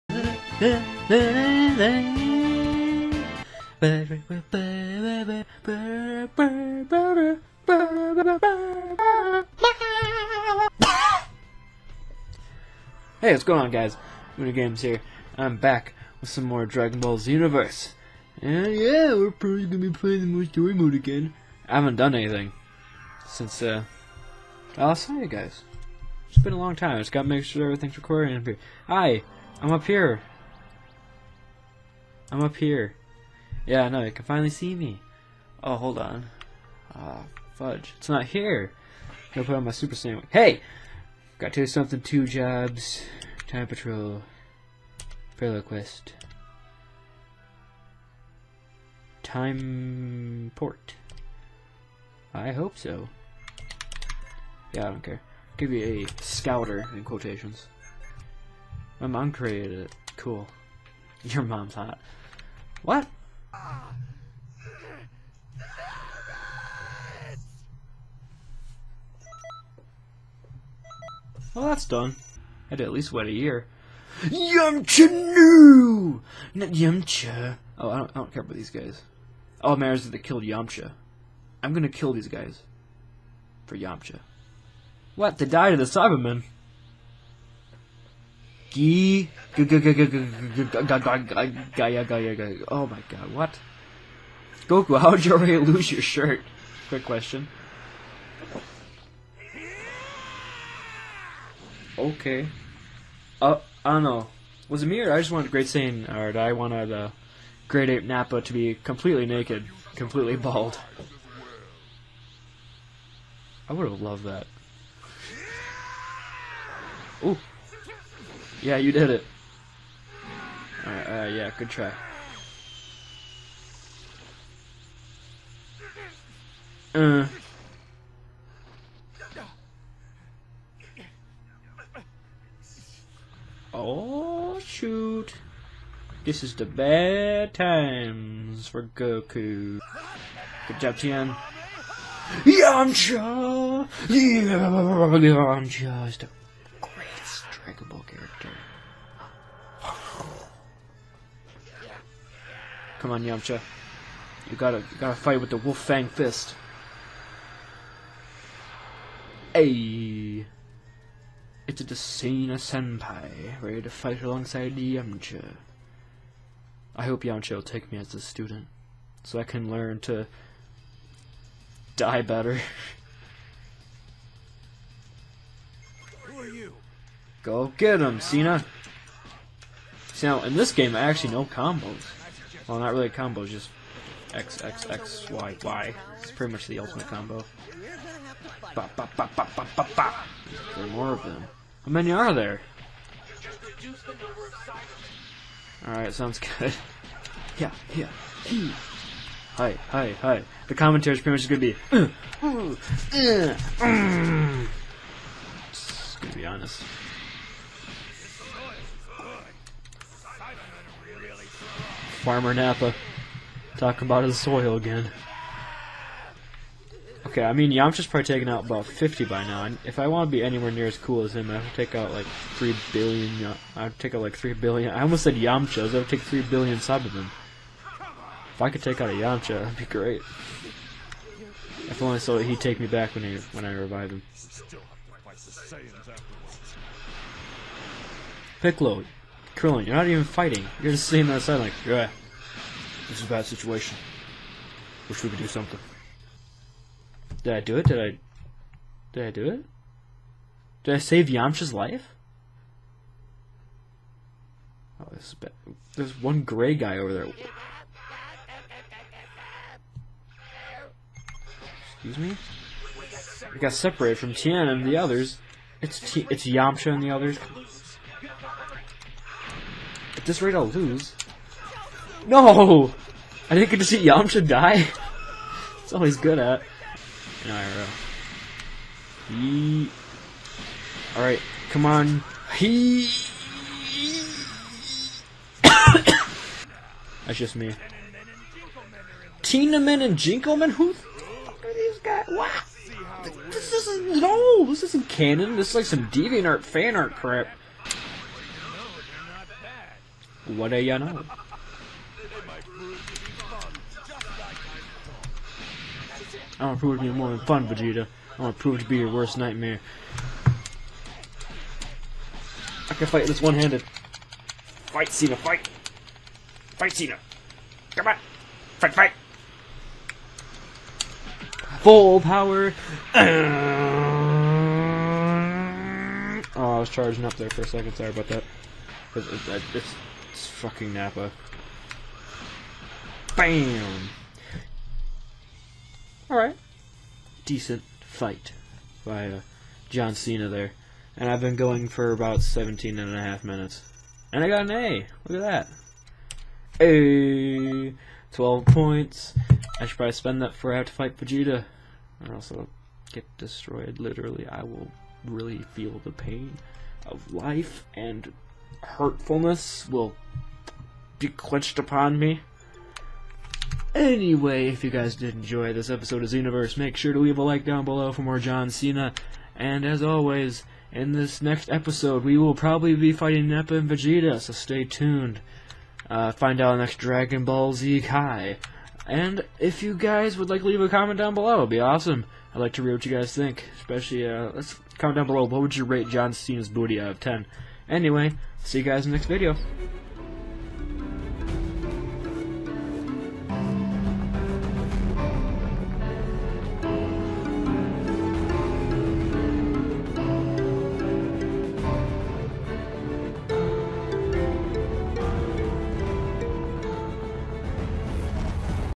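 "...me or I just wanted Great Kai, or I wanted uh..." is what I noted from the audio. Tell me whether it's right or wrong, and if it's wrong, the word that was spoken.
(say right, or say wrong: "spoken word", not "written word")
wrong: "Saiyan", not "Kai".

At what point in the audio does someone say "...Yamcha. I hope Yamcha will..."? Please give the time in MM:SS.
02:44.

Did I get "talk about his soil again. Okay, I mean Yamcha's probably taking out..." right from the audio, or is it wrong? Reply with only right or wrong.
right.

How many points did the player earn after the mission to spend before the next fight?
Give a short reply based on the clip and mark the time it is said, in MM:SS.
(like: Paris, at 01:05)
12, at 05:48.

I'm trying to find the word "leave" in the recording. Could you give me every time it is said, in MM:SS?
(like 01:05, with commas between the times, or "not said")
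06:07, 06:20.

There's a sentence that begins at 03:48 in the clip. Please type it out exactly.
If I could take out a Yamcha, that'd be great.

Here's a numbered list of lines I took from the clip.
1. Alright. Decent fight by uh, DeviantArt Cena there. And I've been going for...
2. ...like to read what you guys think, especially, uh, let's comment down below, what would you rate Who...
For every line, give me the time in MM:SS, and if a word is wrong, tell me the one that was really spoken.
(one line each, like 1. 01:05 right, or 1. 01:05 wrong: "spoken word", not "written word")
1. 05:36 wrong: "John", not "DeviantArt"
2. 06:22 wrong: "John", not "Who".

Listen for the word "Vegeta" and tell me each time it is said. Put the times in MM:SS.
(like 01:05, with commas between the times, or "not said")
05:07, 05:51, 06:13.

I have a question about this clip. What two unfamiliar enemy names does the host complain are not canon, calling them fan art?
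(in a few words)
Tennenman and Jinkoman.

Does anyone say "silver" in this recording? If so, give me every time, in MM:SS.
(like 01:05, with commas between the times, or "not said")
not said.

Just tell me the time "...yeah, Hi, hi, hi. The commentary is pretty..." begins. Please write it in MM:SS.
03:17.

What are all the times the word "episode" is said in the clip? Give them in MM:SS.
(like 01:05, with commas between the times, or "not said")
06:05, 06:11.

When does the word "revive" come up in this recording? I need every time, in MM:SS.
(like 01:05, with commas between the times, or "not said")
03:53.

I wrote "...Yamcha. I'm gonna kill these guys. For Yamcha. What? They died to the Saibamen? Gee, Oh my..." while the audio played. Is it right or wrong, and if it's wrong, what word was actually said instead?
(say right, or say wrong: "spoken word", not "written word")
right.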